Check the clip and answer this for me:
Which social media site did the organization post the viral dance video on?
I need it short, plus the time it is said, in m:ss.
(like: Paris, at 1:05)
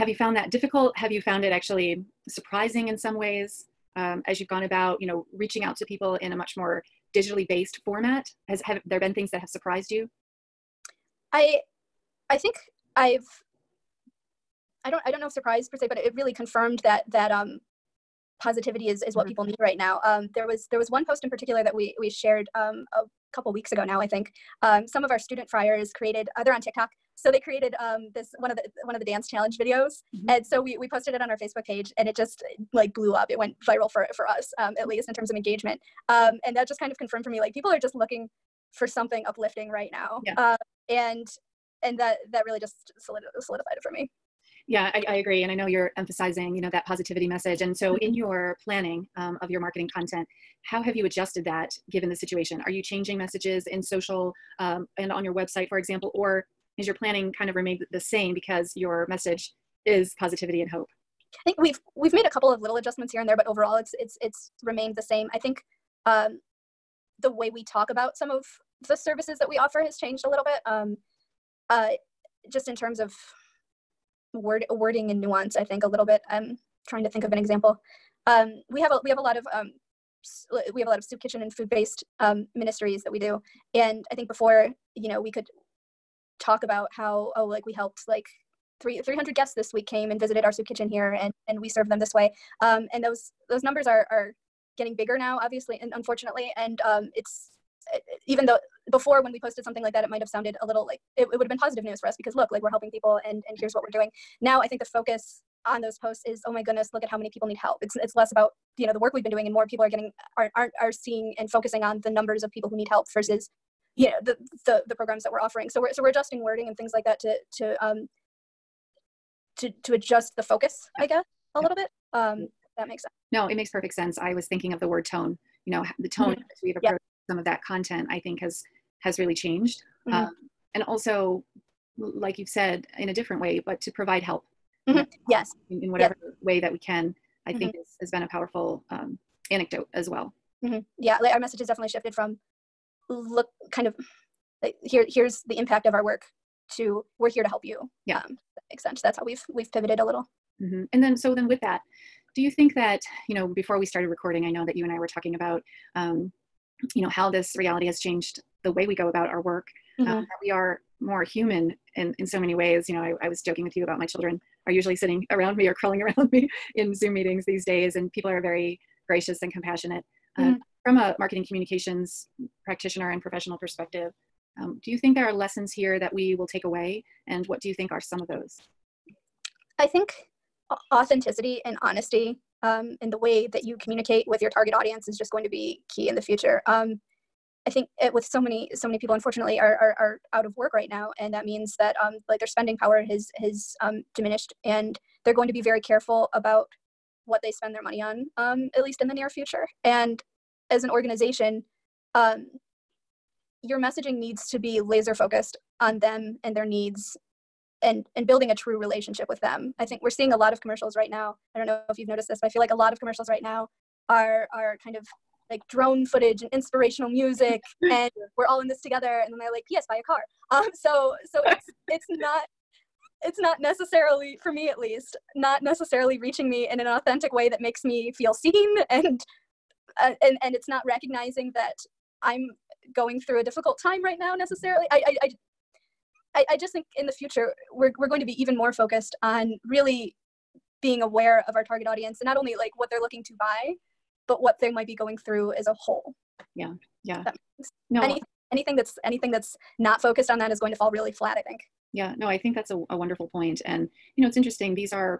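Facebook, at 0:31.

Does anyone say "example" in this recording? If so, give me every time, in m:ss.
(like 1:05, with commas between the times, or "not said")
0:55, 1:17.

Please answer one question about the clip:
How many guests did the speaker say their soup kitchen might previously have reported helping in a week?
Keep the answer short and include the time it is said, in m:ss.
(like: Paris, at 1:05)
300, at 1:29.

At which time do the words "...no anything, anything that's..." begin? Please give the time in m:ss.
4:07.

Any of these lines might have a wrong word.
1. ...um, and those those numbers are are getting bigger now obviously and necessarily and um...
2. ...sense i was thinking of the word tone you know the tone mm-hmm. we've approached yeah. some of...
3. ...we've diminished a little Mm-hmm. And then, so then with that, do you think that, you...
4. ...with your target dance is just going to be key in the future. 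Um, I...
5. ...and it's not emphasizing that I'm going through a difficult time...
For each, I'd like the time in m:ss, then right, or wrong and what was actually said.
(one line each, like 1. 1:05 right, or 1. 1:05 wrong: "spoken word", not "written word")
1. 1:32 wrong: "unfortunately", not "necessarily"
2. 2:03 right
3. 2:29 wrong: "pivoted", not "diminished"
4. 3:04 wrong: "audience", not "dance"
5. 3:50 wrong: "recognizing", not "emphasizing".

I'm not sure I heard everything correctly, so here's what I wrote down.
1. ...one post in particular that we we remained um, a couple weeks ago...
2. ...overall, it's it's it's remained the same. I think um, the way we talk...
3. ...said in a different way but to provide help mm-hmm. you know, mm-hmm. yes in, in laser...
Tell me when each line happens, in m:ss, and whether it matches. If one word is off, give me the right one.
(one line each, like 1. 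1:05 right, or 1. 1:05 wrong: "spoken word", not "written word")
1. 0:20 wrong: "shared", not "remained"
2. 1:03 right
3. 2:12 wrong: "whatever", not "laser".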